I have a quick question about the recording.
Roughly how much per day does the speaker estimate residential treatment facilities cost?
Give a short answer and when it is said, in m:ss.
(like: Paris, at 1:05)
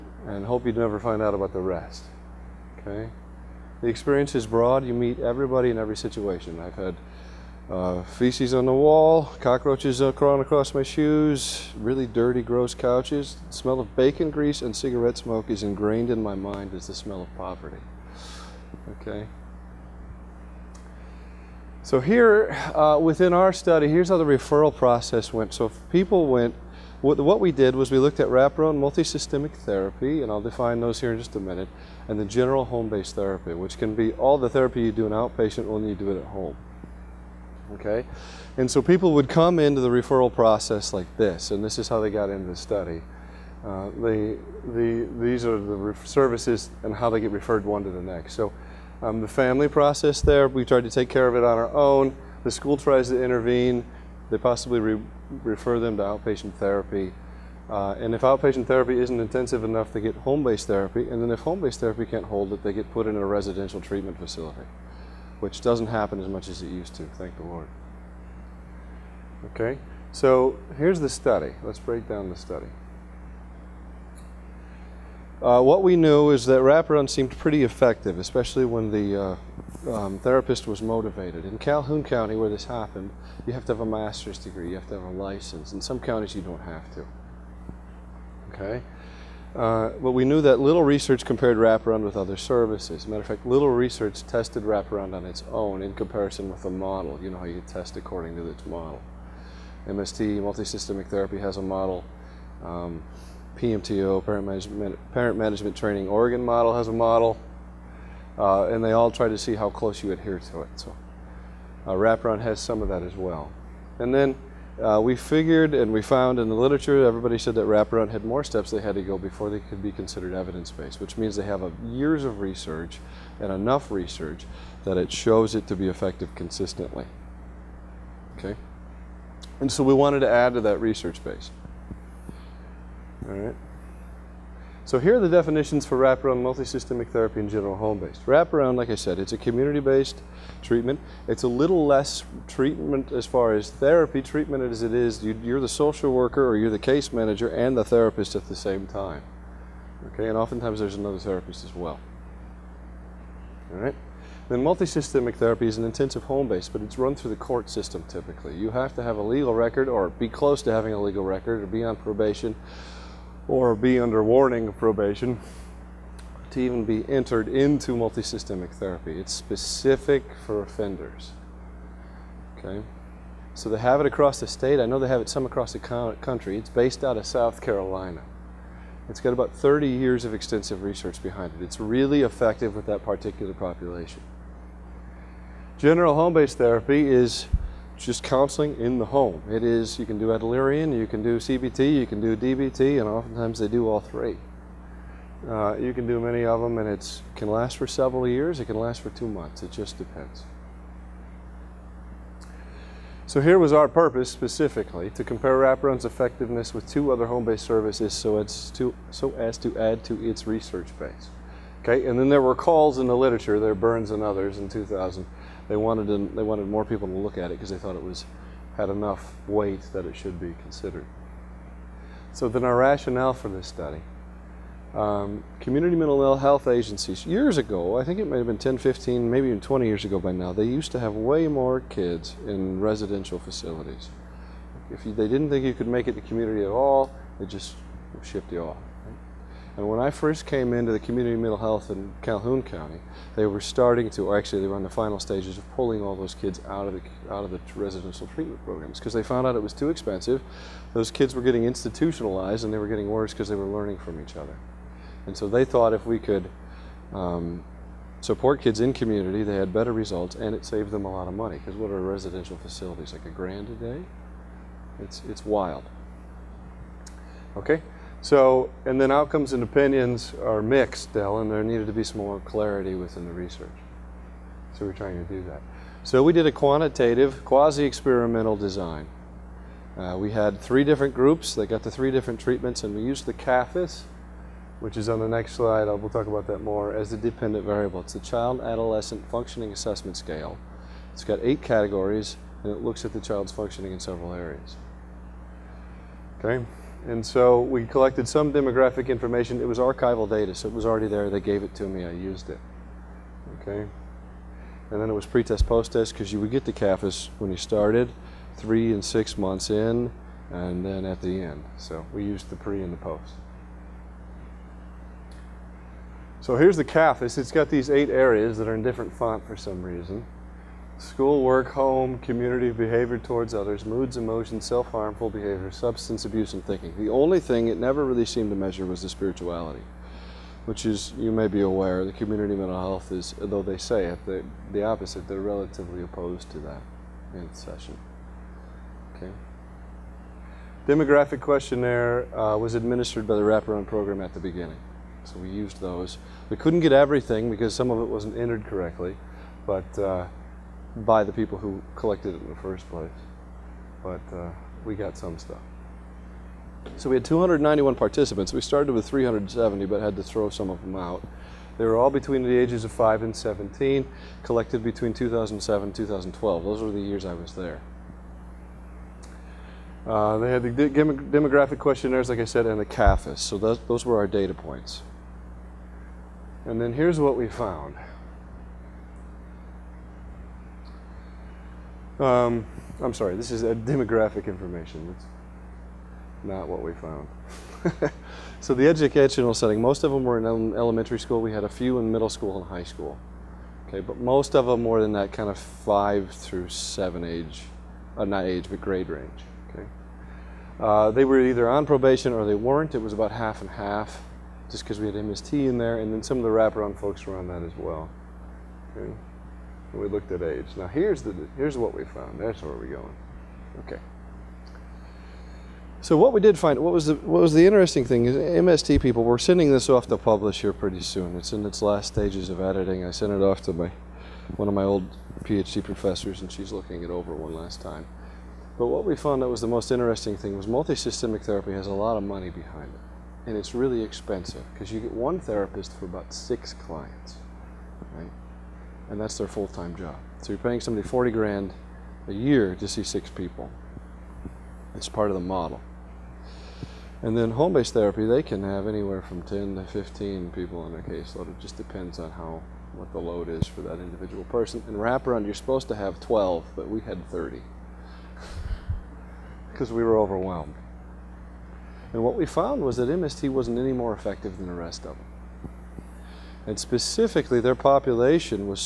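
A grand a day, at 4:23.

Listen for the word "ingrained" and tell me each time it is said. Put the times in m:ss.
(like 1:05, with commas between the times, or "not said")
0:15.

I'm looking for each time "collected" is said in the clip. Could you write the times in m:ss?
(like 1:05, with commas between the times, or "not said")
4:57, 5:51, 6:04.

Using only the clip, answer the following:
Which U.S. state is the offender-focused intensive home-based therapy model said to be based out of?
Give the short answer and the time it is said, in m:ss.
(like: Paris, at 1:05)
South Carolina, at 2:57.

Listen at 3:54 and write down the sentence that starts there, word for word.
If you, they didn't think you could make it to community at all, they just shipped you off.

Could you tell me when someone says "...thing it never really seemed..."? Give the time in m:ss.
5:27.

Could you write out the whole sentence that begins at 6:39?
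Okay, uh, they were either on probation or they weren't.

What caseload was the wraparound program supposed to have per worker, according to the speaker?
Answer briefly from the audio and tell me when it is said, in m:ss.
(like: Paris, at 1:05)
12, at 7:35.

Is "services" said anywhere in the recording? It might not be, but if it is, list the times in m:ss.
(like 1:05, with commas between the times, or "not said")
0:46, 1:32, 3:27.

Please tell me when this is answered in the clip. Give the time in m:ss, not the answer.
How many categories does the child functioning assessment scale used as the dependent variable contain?
4:51.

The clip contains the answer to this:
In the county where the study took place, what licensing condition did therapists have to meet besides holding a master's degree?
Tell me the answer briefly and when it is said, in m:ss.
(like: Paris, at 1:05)
A license, at 1:24.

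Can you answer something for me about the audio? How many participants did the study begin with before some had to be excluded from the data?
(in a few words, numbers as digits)
370.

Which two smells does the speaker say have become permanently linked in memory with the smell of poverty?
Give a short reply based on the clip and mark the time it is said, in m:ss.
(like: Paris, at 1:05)
Bacon grease and cigarette smoke, at 0:13.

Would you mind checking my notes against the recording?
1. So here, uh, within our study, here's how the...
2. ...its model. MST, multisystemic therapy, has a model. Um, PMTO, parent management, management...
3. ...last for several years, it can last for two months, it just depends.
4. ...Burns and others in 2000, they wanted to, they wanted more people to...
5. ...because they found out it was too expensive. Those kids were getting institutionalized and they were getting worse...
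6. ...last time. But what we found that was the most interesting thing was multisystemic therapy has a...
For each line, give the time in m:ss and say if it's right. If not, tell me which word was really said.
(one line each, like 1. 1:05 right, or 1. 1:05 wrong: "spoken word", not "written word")
1. 0:21 right
2. 1:38 wrong: "parent", not "management"
3. 3:17 right
4. 3:33 right
5. 4:08 right
6. 7:07 right.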